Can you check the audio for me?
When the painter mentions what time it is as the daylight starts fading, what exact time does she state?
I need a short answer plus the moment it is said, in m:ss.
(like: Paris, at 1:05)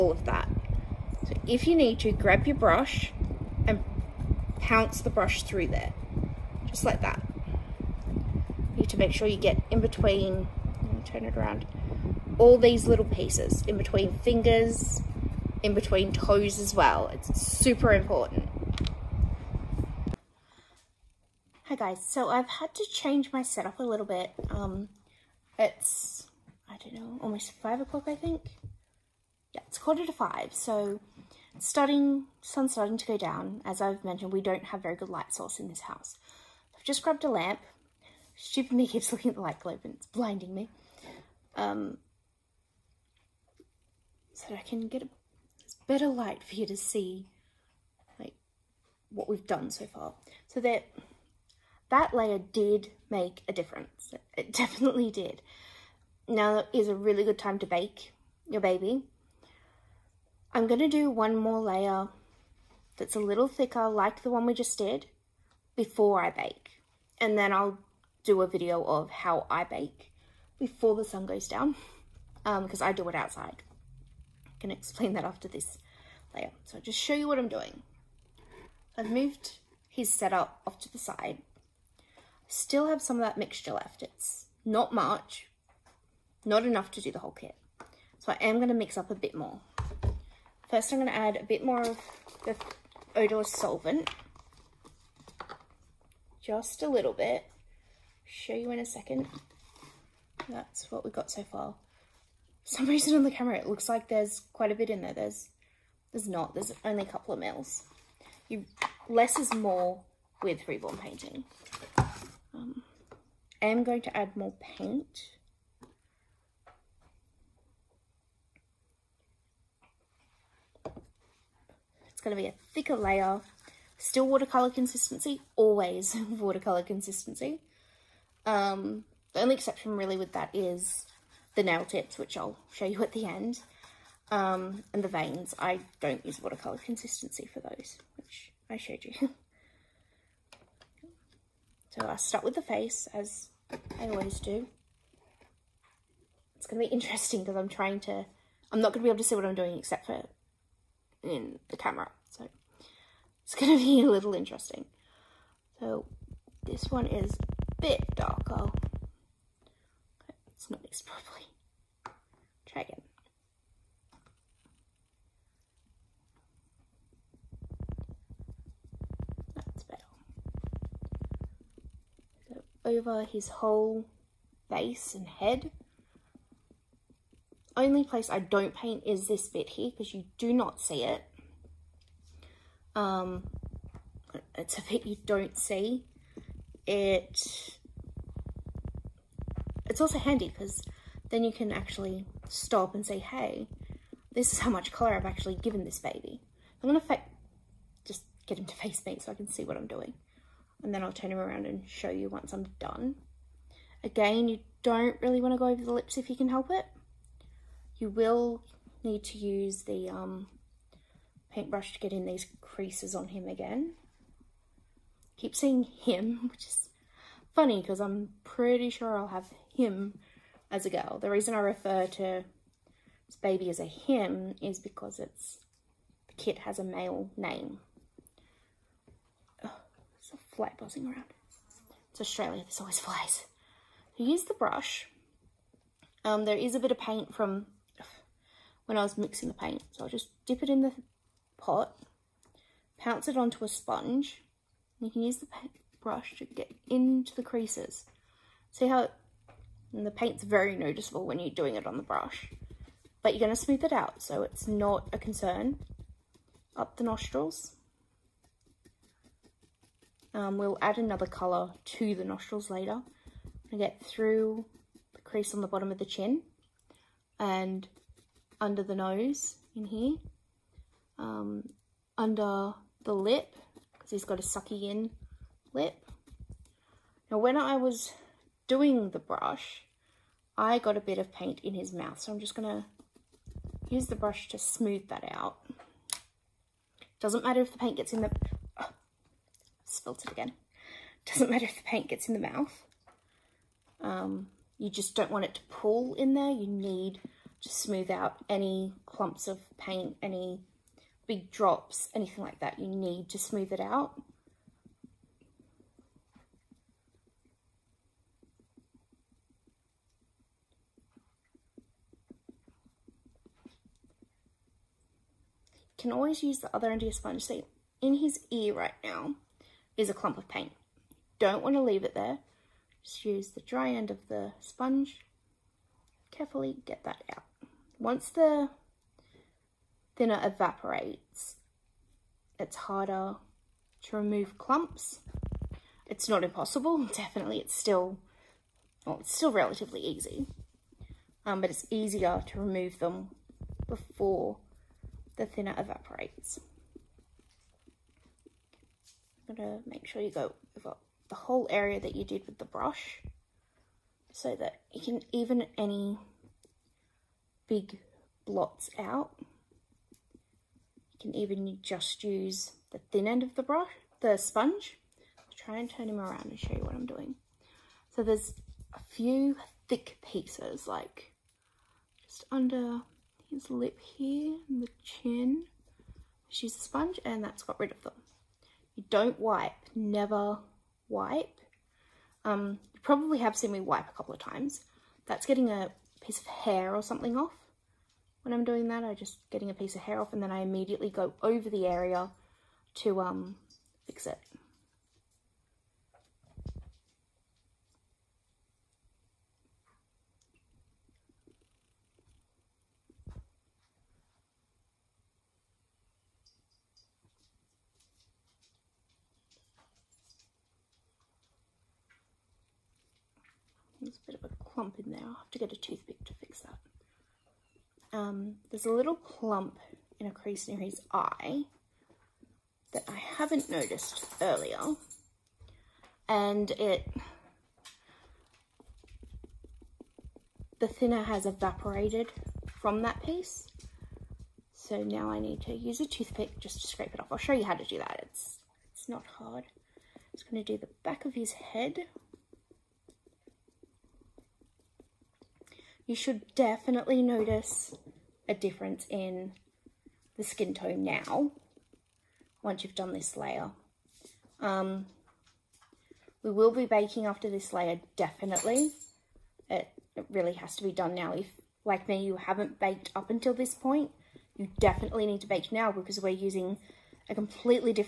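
quarter to 5, at 0:29.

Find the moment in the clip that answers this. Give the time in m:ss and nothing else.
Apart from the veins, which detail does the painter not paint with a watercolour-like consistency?
2:11.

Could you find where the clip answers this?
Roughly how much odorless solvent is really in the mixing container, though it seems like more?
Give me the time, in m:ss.
1:47.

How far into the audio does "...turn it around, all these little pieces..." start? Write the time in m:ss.
0:11.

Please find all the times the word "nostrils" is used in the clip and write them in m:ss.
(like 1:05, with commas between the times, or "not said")
4:17, 4:22.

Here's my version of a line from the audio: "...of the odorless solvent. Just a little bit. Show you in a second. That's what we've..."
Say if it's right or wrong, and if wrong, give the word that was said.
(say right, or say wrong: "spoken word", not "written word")
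right.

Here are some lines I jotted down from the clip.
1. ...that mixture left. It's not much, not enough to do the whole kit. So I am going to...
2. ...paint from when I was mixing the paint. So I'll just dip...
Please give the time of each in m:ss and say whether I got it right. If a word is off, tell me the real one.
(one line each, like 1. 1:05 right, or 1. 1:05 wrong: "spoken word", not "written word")
1. 1:23 right
2. 3:56 right.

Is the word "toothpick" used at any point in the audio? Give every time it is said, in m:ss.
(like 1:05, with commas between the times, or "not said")
6:55, 7:16.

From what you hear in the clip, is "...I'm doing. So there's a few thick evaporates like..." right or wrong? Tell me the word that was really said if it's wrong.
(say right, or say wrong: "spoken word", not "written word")
wrong: "pieces", not "evaporates".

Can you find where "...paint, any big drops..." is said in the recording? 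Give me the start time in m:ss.
4:59.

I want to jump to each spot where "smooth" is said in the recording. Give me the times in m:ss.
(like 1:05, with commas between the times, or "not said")
4:13, 4:44, 4:57, 5:03.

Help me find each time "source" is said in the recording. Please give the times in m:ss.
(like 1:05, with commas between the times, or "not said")
0:35.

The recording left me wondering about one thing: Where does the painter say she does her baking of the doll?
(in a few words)
outside.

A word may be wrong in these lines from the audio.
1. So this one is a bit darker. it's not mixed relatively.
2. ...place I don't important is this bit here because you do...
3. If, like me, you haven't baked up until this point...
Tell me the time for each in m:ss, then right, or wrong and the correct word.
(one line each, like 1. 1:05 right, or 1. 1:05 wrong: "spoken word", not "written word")
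1. 2:35 wrong: "properly", not "relatively"
2. 2:58 wrong: "paint", not "important"
3. 7:41 right.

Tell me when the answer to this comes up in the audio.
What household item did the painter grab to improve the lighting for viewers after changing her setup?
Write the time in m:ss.
0:37.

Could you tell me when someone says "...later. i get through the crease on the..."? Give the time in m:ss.
4:22.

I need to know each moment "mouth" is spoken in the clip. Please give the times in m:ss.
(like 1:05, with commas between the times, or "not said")
4:41, 4:52.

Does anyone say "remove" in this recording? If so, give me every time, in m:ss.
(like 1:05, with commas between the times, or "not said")
5:34, 5:42.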